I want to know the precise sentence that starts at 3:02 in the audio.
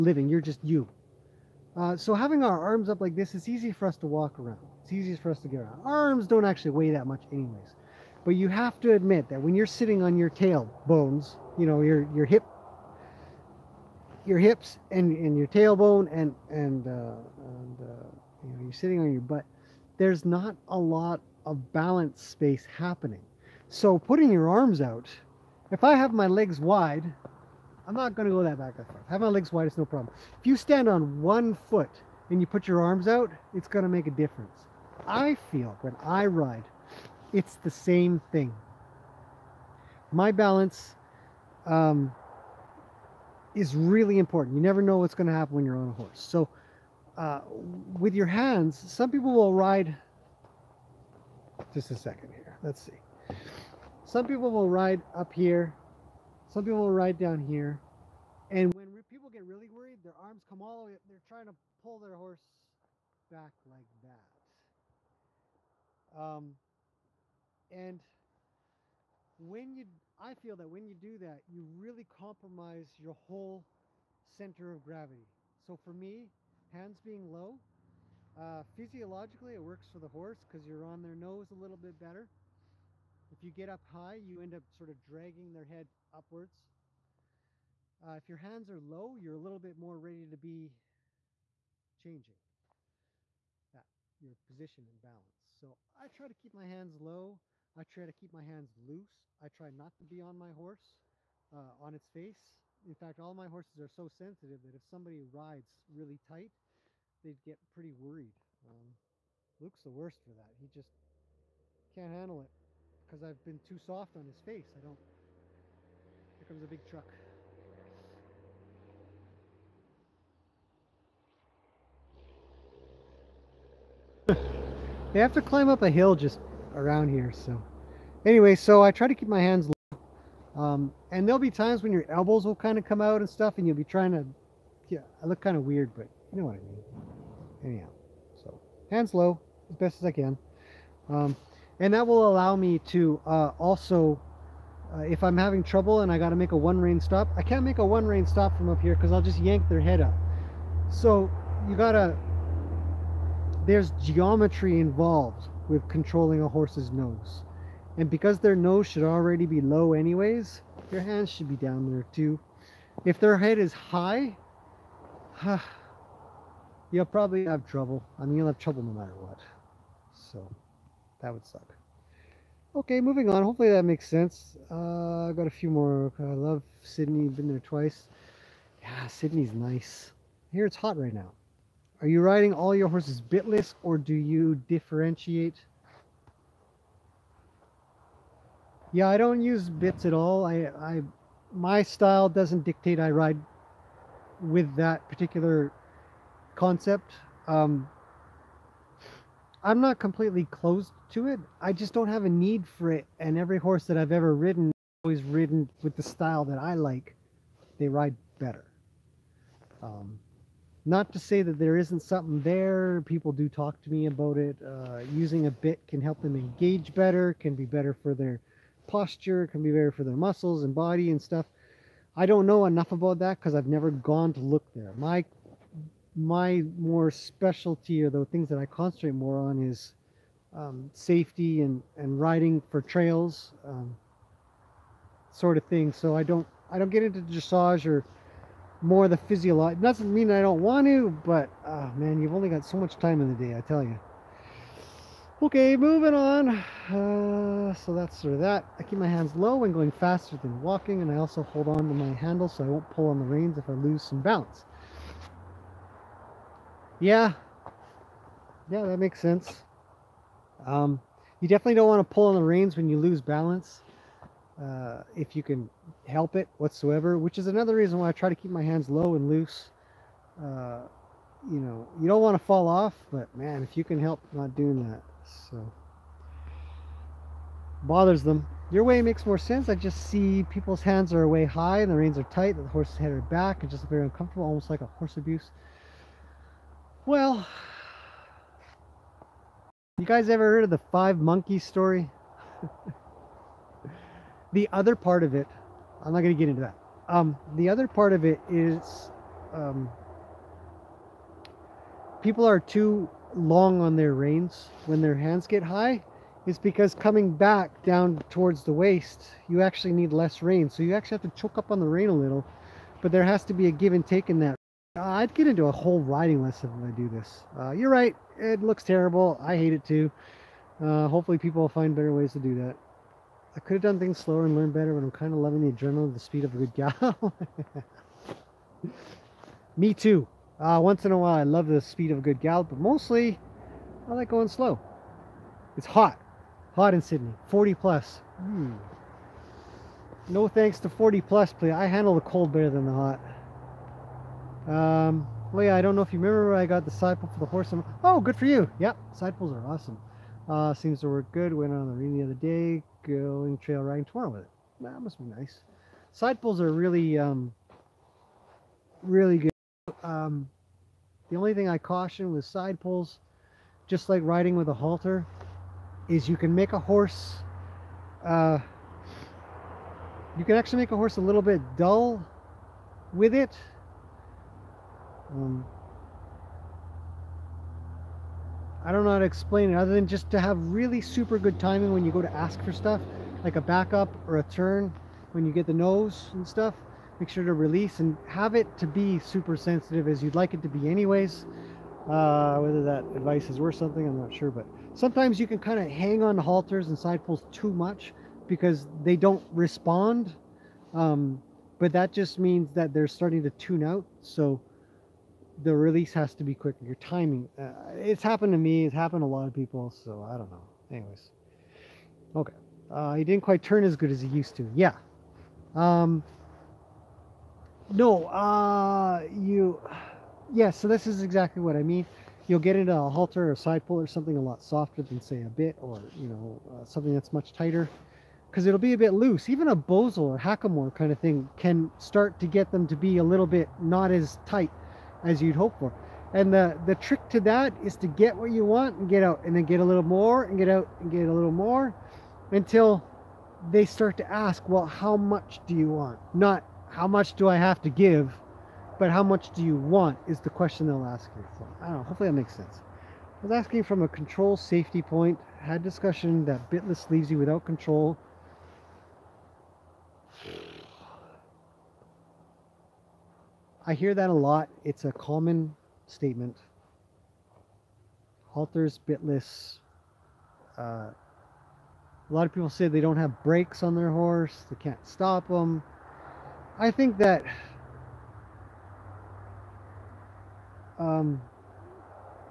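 Are you riding all your horses bitless or do you differentiate?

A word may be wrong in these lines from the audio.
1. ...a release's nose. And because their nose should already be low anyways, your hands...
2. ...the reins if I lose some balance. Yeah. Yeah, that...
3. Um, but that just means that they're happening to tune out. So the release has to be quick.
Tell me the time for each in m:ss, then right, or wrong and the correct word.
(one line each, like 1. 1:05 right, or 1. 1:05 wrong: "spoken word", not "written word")
1. 2:36 wrong: "horse", not "release"
2. 4:13 right
3. 6:40 wrong: "starting", not "happening".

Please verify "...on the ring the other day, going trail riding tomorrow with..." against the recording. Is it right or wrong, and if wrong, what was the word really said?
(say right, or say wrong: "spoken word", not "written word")
right.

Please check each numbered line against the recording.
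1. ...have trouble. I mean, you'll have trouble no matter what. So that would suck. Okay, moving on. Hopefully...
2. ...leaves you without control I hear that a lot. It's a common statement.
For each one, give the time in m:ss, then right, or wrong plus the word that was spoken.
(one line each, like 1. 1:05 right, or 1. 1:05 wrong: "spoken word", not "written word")
1. 2:47 right
2. 7:37 right.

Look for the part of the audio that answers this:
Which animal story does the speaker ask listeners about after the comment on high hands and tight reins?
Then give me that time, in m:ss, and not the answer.
4:50.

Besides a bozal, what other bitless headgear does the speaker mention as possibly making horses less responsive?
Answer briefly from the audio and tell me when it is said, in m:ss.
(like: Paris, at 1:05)
Hackamore, at 7:10.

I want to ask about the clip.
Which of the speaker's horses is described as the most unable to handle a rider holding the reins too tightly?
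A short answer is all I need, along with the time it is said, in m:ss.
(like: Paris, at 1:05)
Luke, at 1:49.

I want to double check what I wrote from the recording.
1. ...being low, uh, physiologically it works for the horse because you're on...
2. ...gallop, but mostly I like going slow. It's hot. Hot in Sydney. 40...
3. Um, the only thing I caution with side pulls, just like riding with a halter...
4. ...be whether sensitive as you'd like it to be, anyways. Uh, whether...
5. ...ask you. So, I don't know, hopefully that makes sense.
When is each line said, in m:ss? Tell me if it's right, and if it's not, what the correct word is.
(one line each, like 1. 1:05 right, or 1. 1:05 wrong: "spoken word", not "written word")
1. 1:17 right
2. 5:32 right
3. 6:00 right
4. 6:28 wrong: "super", not "whether"
5. 7:31 right.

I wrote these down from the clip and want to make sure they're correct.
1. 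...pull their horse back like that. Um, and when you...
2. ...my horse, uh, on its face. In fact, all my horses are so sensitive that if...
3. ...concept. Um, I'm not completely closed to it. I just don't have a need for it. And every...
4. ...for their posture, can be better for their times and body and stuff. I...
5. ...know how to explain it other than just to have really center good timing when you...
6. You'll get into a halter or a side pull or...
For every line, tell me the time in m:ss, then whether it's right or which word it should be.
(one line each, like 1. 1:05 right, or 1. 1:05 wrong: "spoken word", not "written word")
1. 1:01 right
2. 1:40 right
3. 3:16 right
4. 3:38 wrong: "muscles", not "times"
5. 6:19 wrong: "super", not "center"
6. 7:02 right.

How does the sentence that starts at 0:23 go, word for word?
So putting your arms out, if I have my legs wide, I'm not going to go that back and forth.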